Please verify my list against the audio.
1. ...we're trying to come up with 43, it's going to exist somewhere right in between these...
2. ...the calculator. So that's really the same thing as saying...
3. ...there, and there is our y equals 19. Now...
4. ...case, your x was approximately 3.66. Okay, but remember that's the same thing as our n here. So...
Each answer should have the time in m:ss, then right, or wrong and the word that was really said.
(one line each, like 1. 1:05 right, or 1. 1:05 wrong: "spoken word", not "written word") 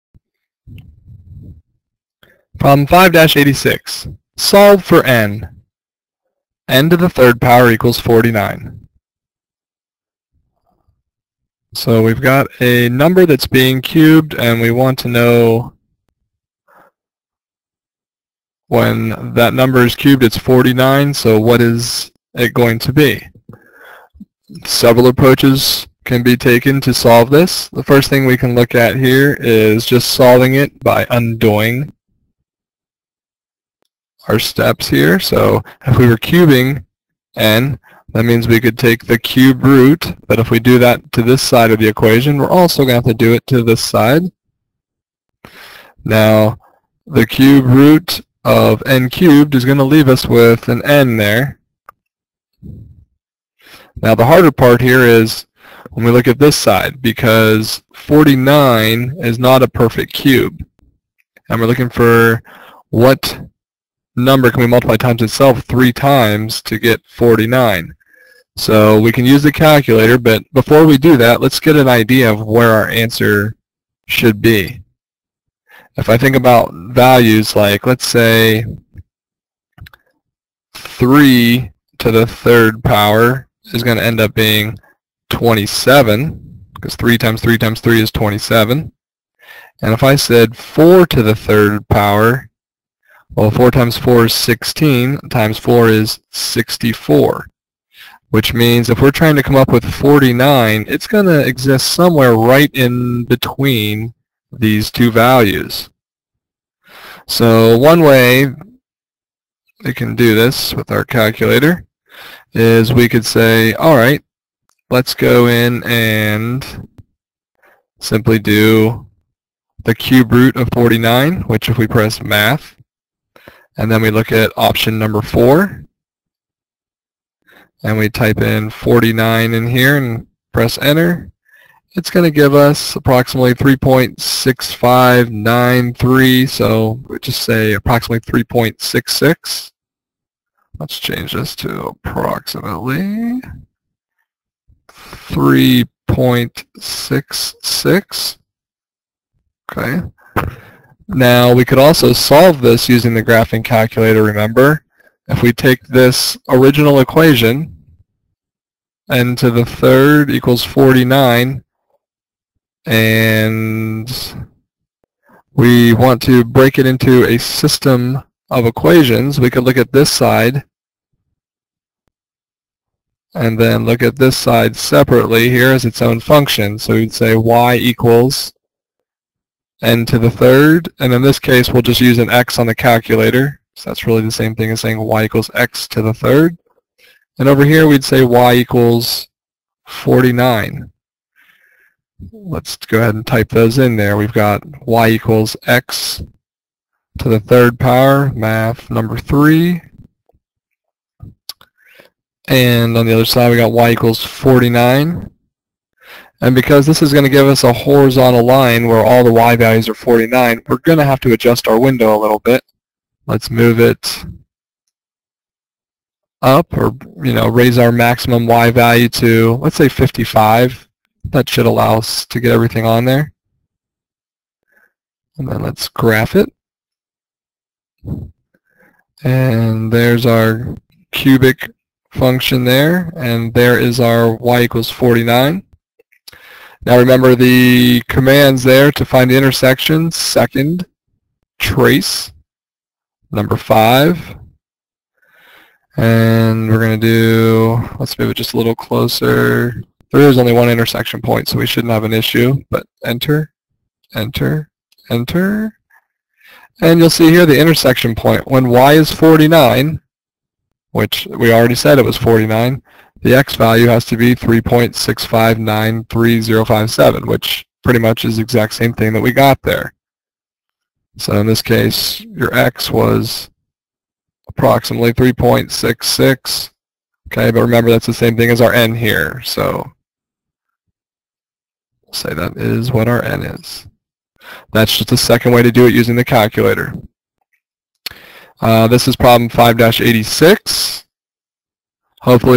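1. 1:39 wrong: "49", not "43"
2. 3:02 right
3. 3:52 wrong: "49", not "19"
4. 4:31 right.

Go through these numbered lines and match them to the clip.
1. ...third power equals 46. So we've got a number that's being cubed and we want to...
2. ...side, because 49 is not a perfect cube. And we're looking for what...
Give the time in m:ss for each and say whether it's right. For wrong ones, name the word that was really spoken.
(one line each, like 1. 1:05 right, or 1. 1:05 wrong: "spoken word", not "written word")
1. 0:07 wrong: "49", not "46"
2. 0:56 right.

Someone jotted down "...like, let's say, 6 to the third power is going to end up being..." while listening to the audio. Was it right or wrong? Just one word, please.
wrong.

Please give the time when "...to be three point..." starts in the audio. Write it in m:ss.
4:24.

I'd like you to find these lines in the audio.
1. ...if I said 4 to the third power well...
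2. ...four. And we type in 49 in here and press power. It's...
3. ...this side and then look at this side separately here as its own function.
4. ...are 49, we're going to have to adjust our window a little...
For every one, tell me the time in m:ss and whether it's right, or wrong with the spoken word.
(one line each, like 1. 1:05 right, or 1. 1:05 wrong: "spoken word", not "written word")
1. 1:29 right
2. 2:05 wrong: "enter", not "power"
3. 2:49 right
4. 3:29 right.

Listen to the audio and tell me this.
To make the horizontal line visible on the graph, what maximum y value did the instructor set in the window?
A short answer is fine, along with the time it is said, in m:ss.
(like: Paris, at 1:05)
55, at 3:39.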